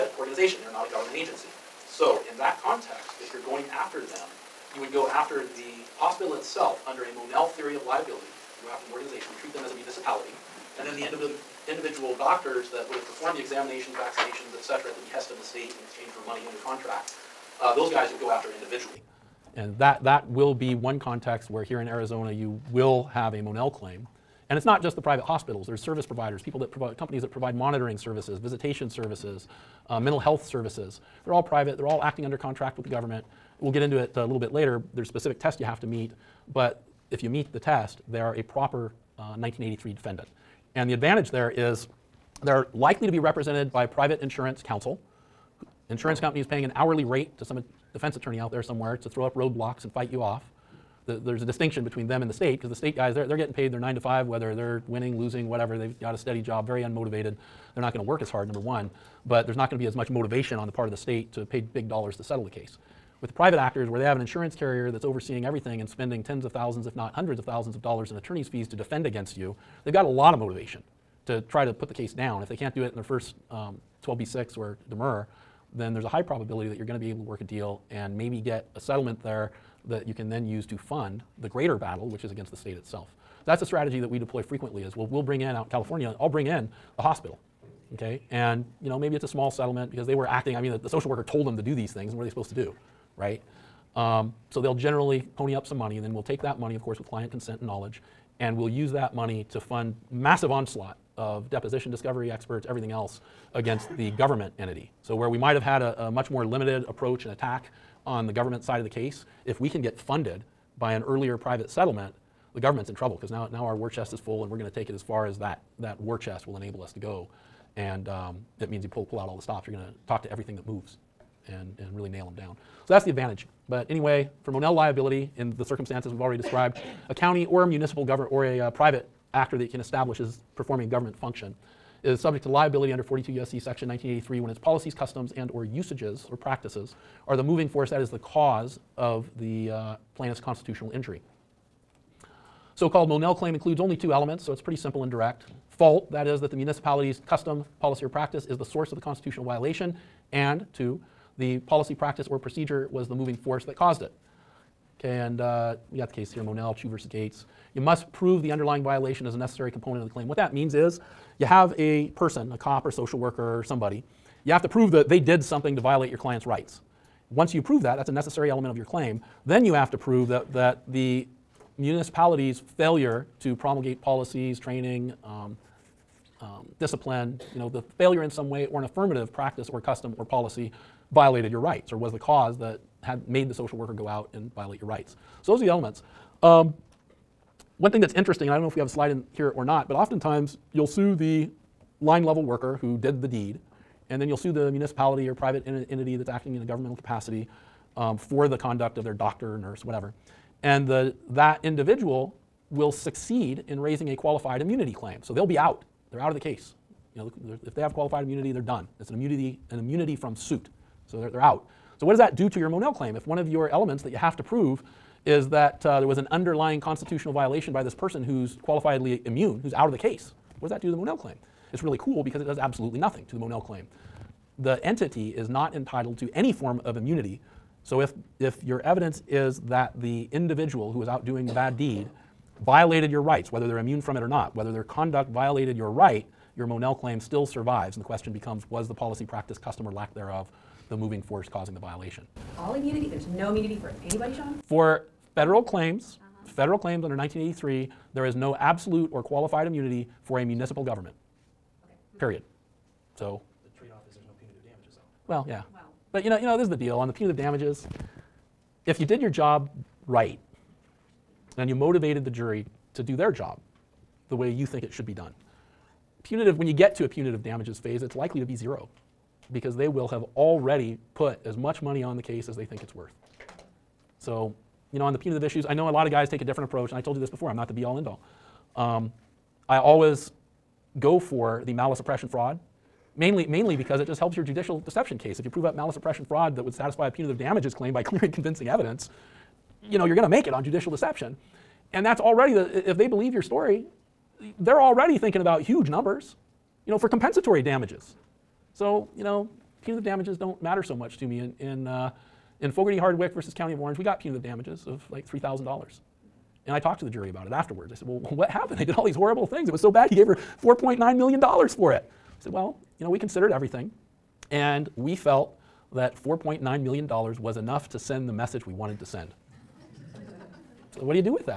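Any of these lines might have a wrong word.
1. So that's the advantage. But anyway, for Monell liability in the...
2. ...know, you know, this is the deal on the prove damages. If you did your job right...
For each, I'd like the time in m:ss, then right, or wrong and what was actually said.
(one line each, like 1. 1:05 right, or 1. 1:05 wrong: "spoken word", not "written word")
1. 2:02 right
2. 4:16 wrong: "punitive", not "prove".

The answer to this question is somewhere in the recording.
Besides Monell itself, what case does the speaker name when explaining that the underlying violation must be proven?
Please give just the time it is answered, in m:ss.
2:36.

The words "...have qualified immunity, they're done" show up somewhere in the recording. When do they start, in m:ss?
3:27.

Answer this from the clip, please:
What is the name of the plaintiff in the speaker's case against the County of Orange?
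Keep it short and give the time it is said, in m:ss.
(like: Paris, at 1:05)
Fogarty Hardwick, at 5:02.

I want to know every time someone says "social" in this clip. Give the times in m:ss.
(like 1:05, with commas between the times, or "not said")
1:30, 2:42, 3:03.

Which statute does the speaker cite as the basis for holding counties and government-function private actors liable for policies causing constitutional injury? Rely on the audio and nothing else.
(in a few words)
42 USC section 1983.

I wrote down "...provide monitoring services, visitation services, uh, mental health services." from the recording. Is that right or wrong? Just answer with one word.
right.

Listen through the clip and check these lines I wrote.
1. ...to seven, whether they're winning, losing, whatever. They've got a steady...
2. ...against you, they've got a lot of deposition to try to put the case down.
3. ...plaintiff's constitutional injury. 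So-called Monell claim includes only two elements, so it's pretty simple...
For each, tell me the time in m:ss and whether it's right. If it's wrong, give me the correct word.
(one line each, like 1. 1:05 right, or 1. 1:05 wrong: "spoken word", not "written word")
1. 0:53 wrong: "five", not "seven"
2. 1:09 wrong: "motivation", not "deposition"
3. 2:20 right.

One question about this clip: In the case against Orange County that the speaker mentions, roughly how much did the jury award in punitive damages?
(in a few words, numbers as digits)
$3,000.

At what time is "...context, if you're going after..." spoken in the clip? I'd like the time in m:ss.
0:02.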